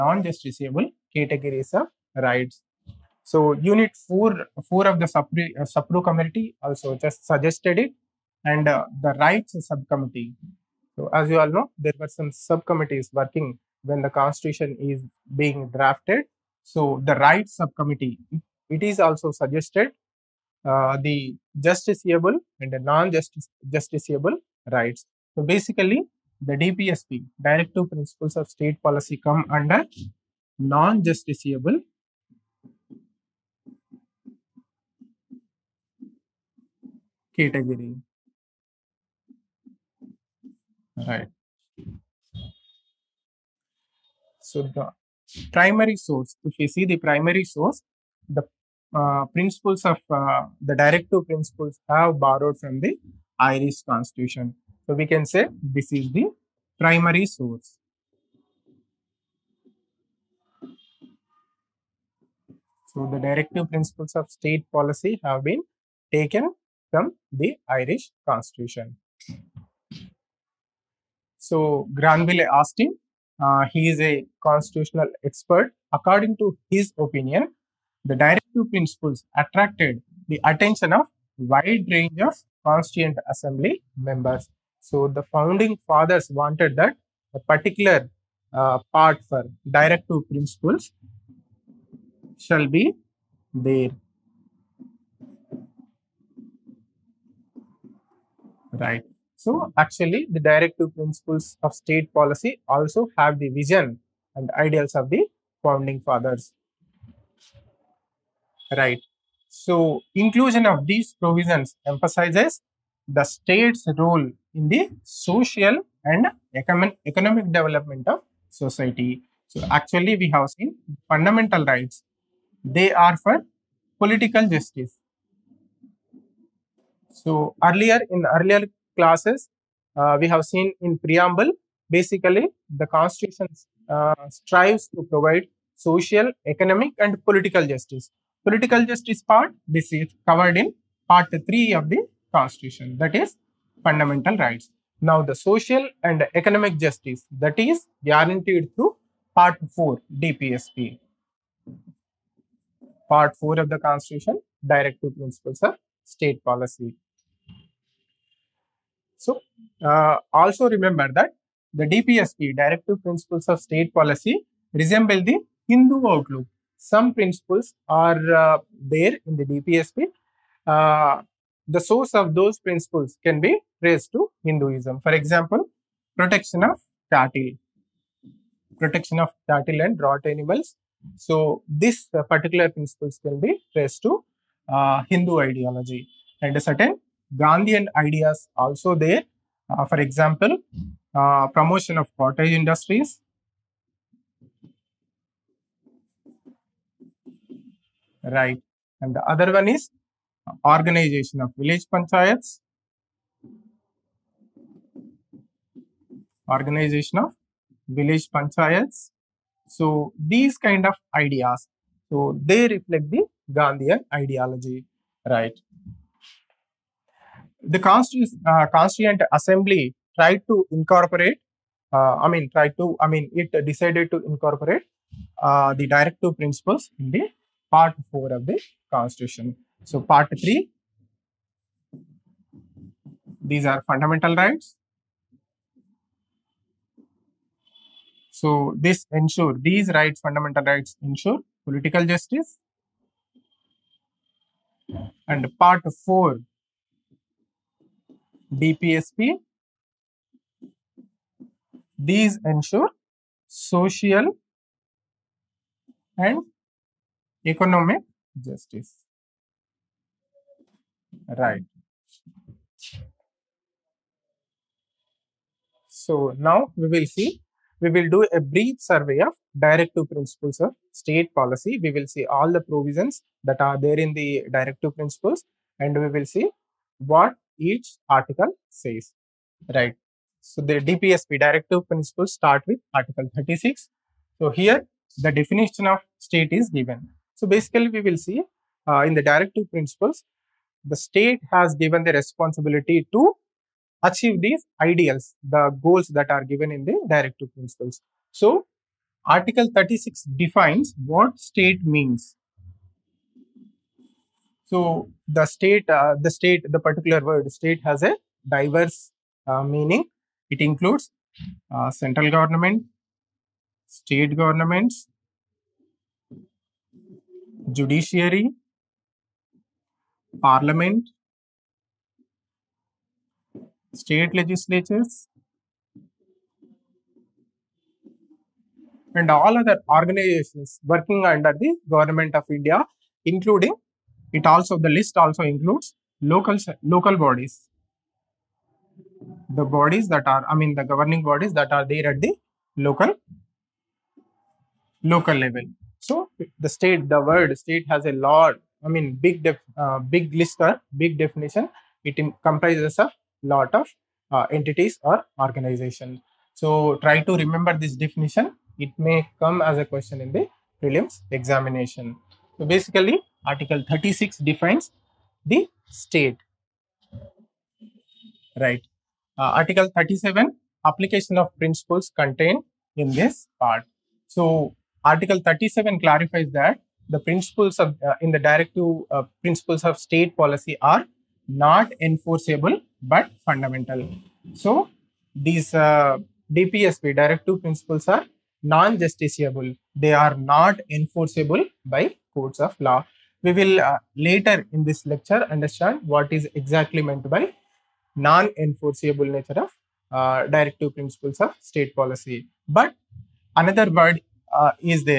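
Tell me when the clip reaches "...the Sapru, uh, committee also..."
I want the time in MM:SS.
00:04.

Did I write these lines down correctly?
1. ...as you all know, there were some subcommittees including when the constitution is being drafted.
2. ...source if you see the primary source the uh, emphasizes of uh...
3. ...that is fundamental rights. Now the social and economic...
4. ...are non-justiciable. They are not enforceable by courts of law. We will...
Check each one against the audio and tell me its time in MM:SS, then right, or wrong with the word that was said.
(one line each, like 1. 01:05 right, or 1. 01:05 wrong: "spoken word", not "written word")
1. 00:11 wrong: "working", not "including"
2. 00:46 wrong: "principles", not "emphasizes"
3. 02:22 right
4. 06:28 right.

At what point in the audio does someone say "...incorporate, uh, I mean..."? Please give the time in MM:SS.
03:40.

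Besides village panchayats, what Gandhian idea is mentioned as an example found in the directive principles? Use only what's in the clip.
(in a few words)
Promotion of cottage industries.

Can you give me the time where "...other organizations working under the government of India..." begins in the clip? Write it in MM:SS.
05:29.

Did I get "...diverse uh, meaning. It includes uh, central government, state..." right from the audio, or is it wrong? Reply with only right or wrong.
right.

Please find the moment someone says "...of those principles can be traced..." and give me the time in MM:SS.
02:52.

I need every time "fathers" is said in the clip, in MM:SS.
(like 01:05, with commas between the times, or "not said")
01:25, 01:45.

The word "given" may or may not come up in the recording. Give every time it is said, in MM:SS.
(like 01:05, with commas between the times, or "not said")
04:46, 04:51, 04:56.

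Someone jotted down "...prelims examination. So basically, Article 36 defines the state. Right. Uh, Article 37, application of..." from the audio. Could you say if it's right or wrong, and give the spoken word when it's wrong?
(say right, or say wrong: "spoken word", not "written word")
right.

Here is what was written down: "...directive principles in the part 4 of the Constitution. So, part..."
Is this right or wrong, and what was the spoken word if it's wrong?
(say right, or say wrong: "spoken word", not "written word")
right.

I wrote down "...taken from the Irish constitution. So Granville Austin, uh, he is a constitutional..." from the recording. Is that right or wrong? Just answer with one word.
right.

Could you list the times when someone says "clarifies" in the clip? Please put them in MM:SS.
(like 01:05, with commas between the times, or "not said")
06:15.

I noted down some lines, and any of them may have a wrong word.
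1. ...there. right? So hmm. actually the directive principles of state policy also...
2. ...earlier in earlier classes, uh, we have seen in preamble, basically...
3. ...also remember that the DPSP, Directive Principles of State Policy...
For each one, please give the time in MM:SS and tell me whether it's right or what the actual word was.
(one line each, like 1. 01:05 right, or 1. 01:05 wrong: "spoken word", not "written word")
1. 01:33 right
2. 02:07 right
3. 02:40 right.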